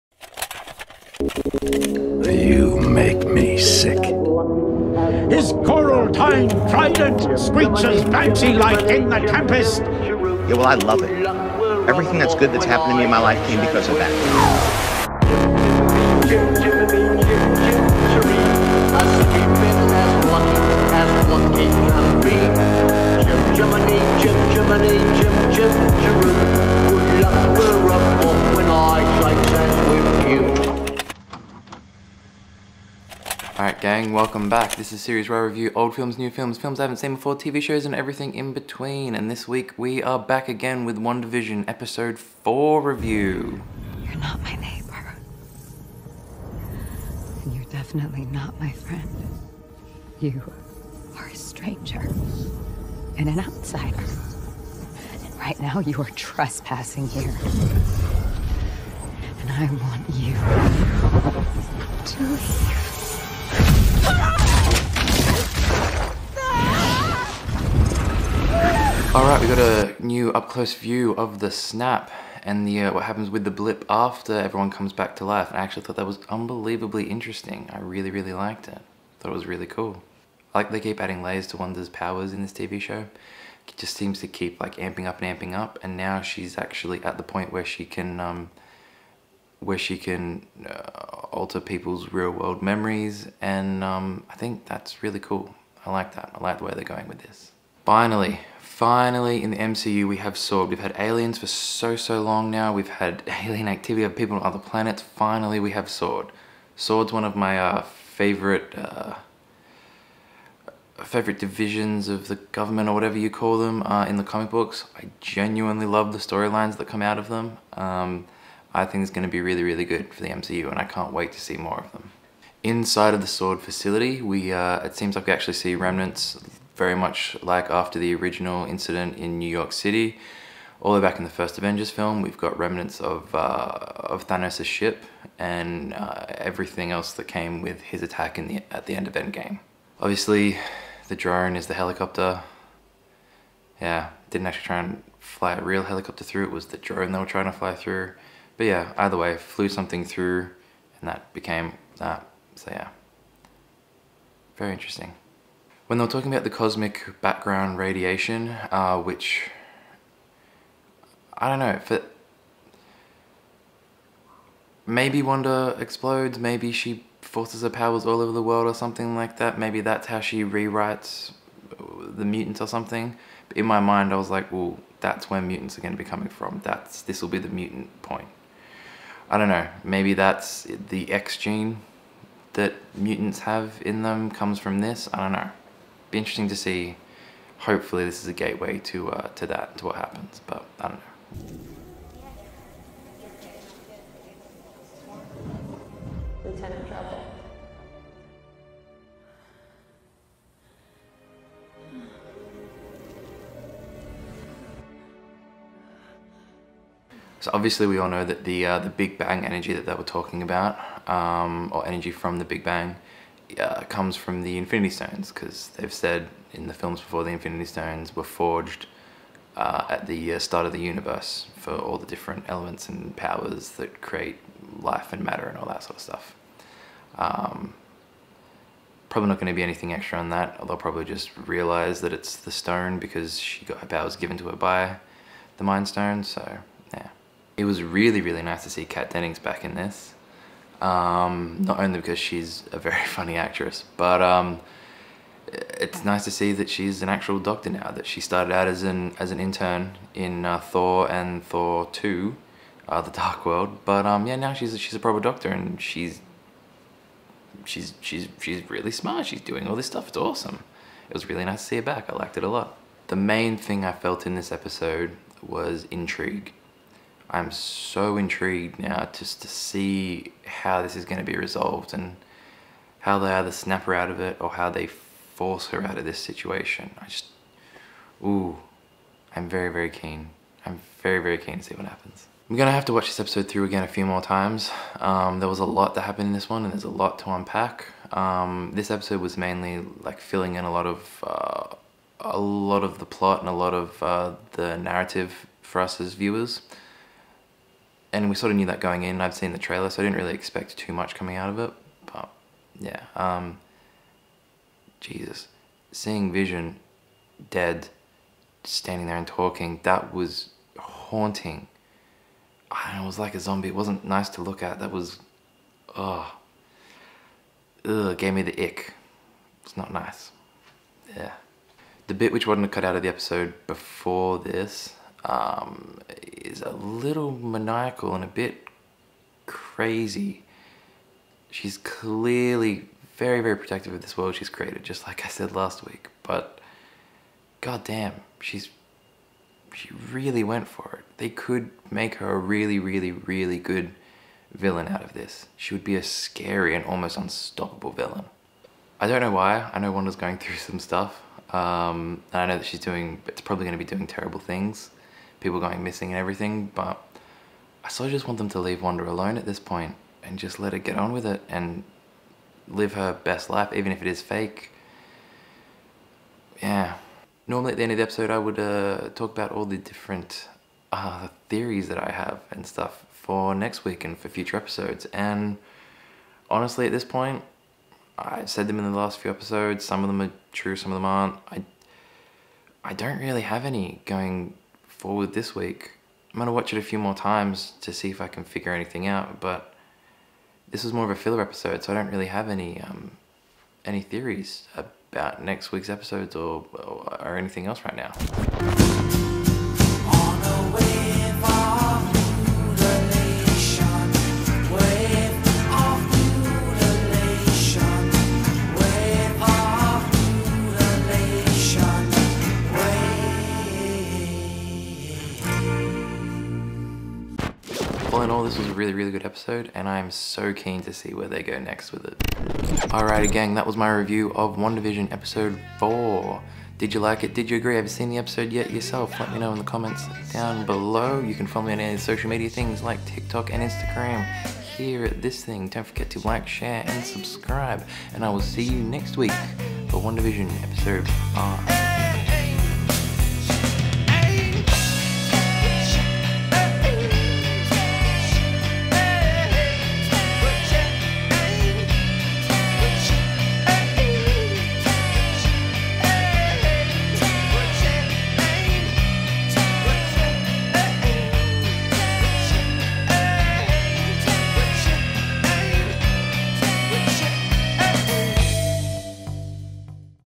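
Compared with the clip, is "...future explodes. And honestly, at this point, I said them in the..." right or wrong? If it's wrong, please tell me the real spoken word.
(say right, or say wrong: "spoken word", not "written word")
wrong: "episodes", not "explodes".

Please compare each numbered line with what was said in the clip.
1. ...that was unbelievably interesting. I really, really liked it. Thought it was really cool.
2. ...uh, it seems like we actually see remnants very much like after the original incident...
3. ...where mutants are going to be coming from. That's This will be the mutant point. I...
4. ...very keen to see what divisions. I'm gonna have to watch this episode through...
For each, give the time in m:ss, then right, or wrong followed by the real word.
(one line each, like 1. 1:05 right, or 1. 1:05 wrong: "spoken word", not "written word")
1. 1:15 right
2. 2:04 right
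3. 2:55 right
4. 4:41 wrong: "happens", not "divisions".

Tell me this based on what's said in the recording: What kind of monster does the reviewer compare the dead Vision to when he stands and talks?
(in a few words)
A zombie.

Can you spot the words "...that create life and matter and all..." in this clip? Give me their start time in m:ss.
3:43.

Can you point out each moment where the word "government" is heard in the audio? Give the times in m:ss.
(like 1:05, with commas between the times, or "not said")
1:52.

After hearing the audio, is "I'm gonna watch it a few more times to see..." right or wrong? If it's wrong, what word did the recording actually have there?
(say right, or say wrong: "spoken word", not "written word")
right.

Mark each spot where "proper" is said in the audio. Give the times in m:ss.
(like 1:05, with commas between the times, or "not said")
4:14.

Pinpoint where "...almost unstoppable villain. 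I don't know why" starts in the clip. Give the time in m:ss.
5:46.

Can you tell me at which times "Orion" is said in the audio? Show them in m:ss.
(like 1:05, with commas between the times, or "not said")
not said.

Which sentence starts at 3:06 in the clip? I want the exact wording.
Be interesting to see, hopefully this is a gateway to, uh, to that, to what happens, but I don't know.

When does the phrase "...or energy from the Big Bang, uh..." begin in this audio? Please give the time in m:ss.
3:31.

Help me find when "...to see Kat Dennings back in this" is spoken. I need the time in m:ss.
3:58.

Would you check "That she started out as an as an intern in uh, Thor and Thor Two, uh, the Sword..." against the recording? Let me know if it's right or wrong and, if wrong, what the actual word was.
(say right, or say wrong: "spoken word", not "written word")
wrong: "Dark", not "Sword".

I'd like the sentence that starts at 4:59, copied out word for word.
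I'd seen the trailer, so I didn't really expect too much coming out of it.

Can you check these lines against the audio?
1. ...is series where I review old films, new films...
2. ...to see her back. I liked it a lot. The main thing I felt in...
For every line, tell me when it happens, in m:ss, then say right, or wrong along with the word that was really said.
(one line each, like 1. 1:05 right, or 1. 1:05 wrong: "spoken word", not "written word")
1. 0:34 right
2. 4:21 right.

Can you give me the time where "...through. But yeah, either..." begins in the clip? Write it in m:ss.
2:27.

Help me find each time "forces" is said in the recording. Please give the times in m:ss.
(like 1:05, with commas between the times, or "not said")
2:47, 4:34.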